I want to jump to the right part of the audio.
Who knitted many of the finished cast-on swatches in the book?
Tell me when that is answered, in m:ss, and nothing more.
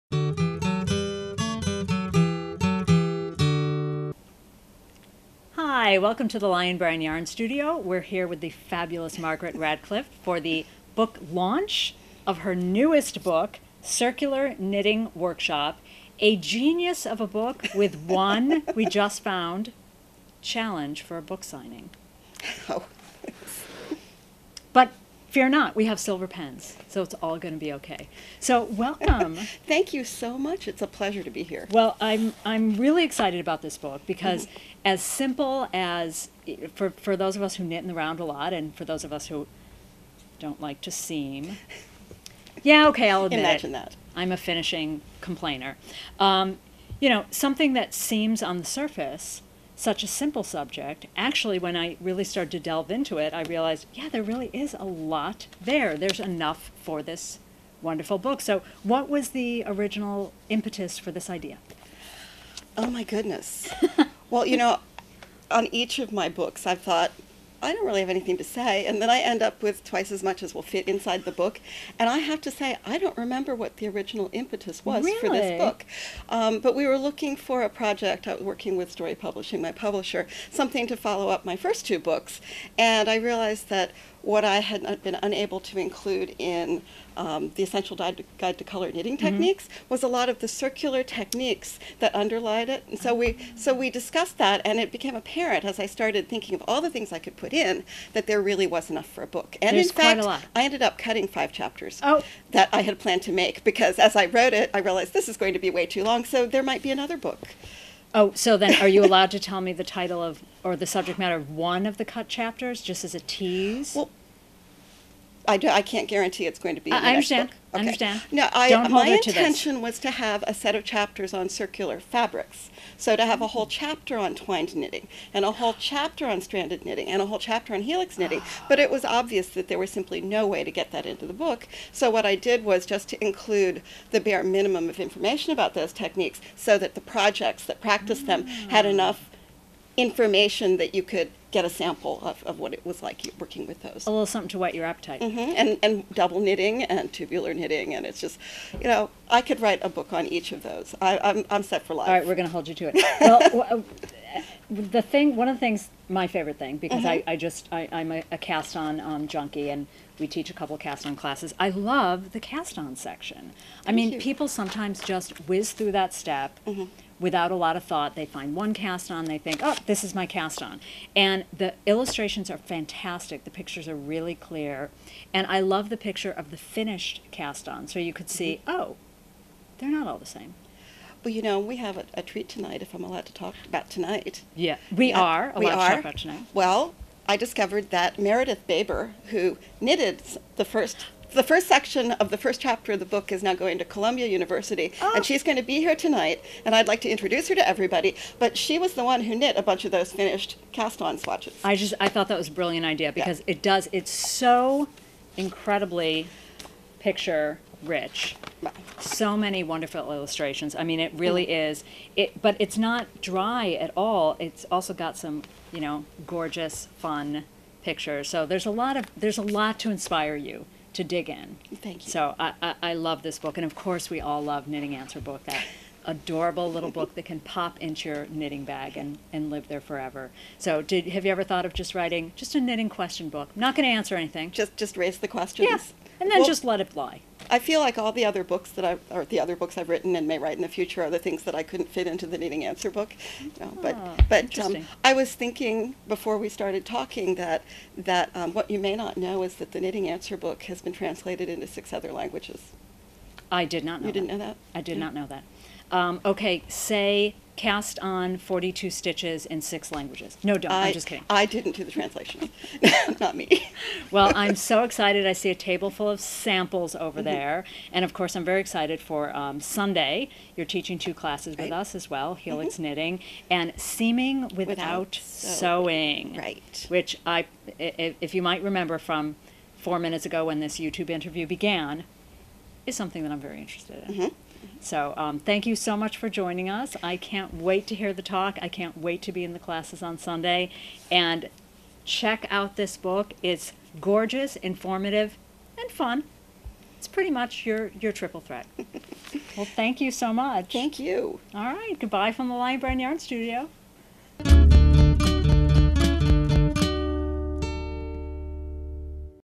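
3:08.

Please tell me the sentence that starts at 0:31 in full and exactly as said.
Well, I'm I'm really excited about this book because, mm -hmm.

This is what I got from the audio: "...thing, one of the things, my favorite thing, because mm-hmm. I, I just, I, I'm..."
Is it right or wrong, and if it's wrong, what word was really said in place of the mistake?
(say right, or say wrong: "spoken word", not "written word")
right.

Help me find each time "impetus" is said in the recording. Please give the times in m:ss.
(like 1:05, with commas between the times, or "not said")
1:00, 1:14.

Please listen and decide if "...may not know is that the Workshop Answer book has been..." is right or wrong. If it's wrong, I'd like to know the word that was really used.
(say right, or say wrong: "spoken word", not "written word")
wrong: "Knitting", not "Workshop".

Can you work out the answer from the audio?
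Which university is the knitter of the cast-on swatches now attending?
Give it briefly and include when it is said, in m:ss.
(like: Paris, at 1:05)
Columbia University, at 3:13.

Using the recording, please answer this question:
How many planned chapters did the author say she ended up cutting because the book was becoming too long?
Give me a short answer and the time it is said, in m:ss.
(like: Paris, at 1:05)
5, at 1:41.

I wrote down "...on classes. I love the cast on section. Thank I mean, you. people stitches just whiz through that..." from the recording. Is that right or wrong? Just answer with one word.
wrong.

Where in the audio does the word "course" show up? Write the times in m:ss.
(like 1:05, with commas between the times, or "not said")
3:43, 4:28.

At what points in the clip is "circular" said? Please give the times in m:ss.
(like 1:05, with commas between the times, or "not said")
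0:13, 1:30, 2:01.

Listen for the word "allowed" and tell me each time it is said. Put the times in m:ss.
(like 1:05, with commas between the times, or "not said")
1:49, 3:03.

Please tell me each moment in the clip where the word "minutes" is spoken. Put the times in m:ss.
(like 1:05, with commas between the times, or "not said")
4:39.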